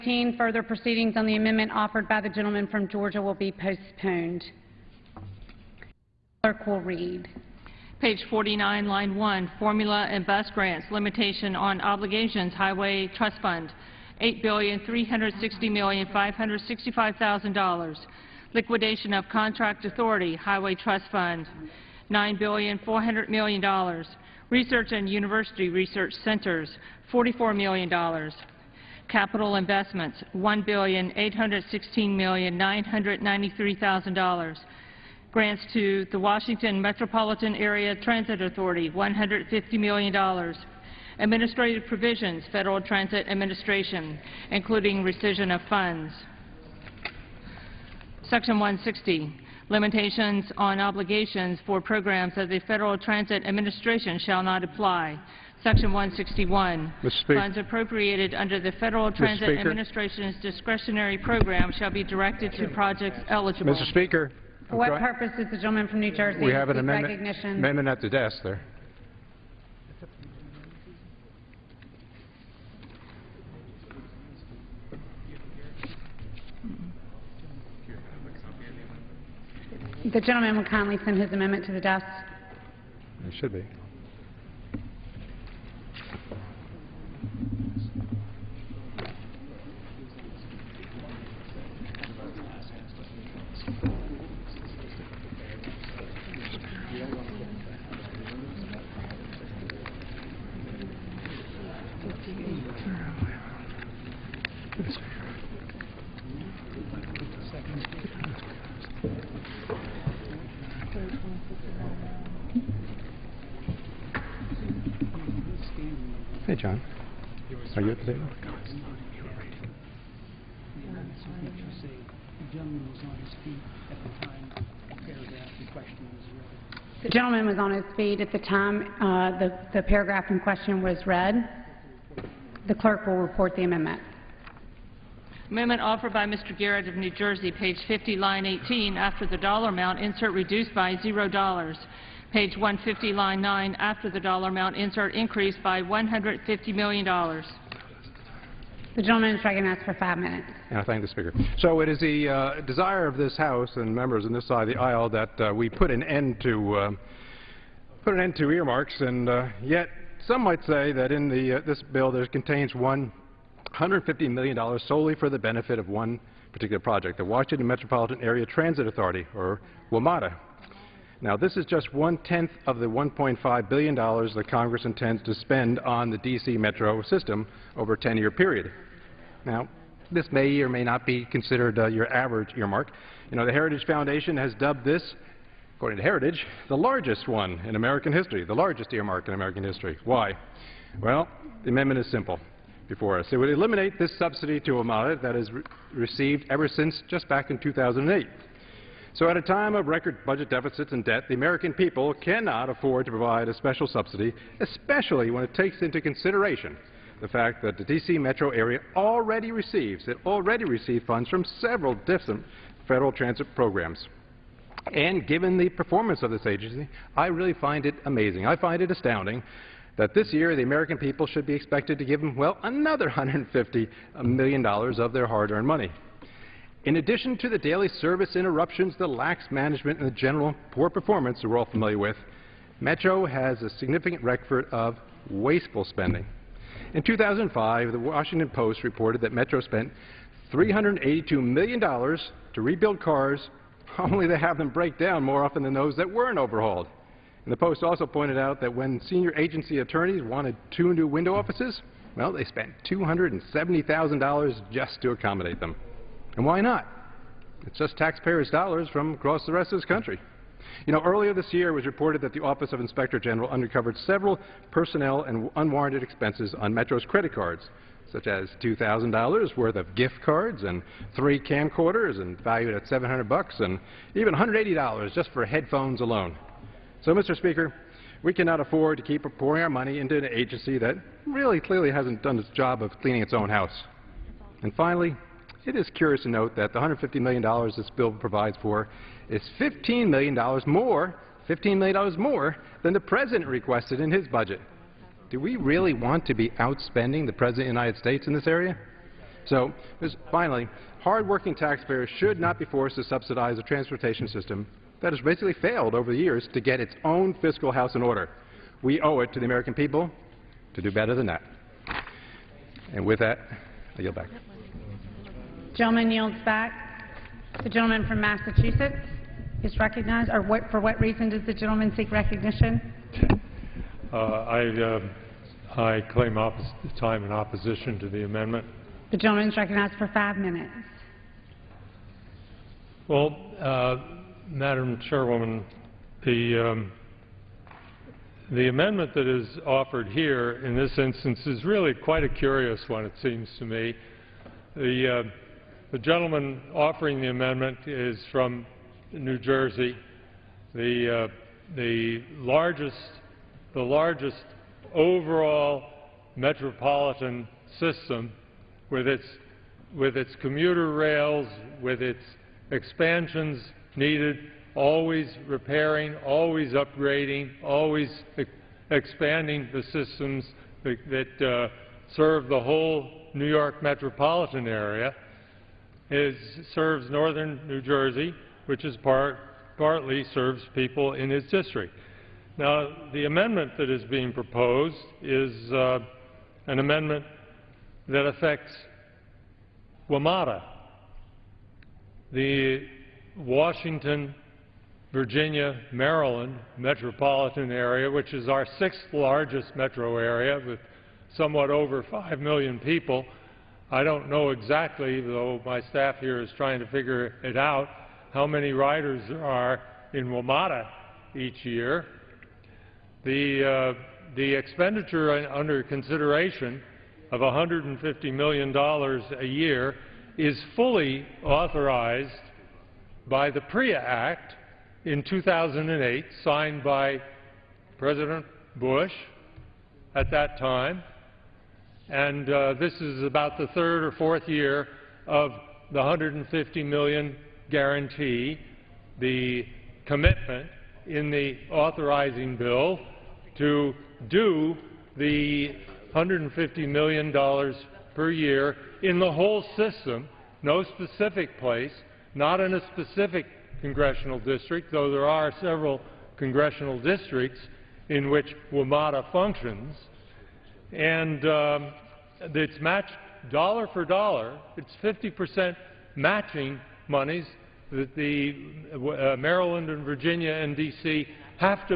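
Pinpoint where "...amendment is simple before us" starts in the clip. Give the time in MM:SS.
03:11.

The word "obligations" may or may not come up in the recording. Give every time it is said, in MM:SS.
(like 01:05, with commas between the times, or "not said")
00:11, 00:50.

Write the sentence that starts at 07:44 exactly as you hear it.
It's 50 percent matching monies that the uh, Maryland and Virginia and D.C.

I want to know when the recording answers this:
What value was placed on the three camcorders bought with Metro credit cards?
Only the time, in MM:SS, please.
04:32.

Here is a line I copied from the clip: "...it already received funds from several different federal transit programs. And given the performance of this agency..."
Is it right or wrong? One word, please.
right.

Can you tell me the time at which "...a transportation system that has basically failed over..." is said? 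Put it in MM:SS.
05:03.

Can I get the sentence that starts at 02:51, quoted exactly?
Now, this is just one-tenth of the $1.5 billion that Congress intends to spend on the D.C.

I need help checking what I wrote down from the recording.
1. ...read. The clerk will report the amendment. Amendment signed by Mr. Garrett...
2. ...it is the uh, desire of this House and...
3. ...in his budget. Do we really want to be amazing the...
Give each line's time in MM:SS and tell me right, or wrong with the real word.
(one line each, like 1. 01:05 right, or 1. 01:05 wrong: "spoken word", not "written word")
1. 02:11 wrong: "offered", not "signed"
2. 02:31 right
3. 04:53 wrong: "outspending", not "amazing".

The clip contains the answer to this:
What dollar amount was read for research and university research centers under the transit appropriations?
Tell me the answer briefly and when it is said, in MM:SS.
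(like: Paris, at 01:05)
$44 million, at 00:27.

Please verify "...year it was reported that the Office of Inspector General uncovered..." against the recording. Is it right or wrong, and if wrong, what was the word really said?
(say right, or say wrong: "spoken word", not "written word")
right.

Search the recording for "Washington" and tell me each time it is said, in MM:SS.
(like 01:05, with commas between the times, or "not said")
00:36, 02:47, 03:57, 06:33.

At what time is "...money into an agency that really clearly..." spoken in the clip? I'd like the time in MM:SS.
04:39.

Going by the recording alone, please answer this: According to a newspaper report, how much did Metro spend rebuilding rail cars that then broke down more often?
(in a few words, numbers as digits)
$382 million.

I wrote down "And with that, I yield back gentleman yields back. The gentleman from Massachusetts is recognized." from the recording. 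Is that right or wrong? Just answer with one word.
right.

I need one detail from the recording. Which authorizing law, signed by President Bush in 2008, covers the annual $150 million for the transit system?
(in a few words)
PRIIA Act.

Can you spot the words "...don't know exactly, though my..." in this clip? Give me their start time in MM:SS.
06:44.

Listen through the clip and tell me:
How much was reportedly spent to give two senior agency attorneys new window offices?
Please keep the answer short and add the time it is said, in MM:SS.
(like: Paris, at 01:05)
$270,000, at 04:12.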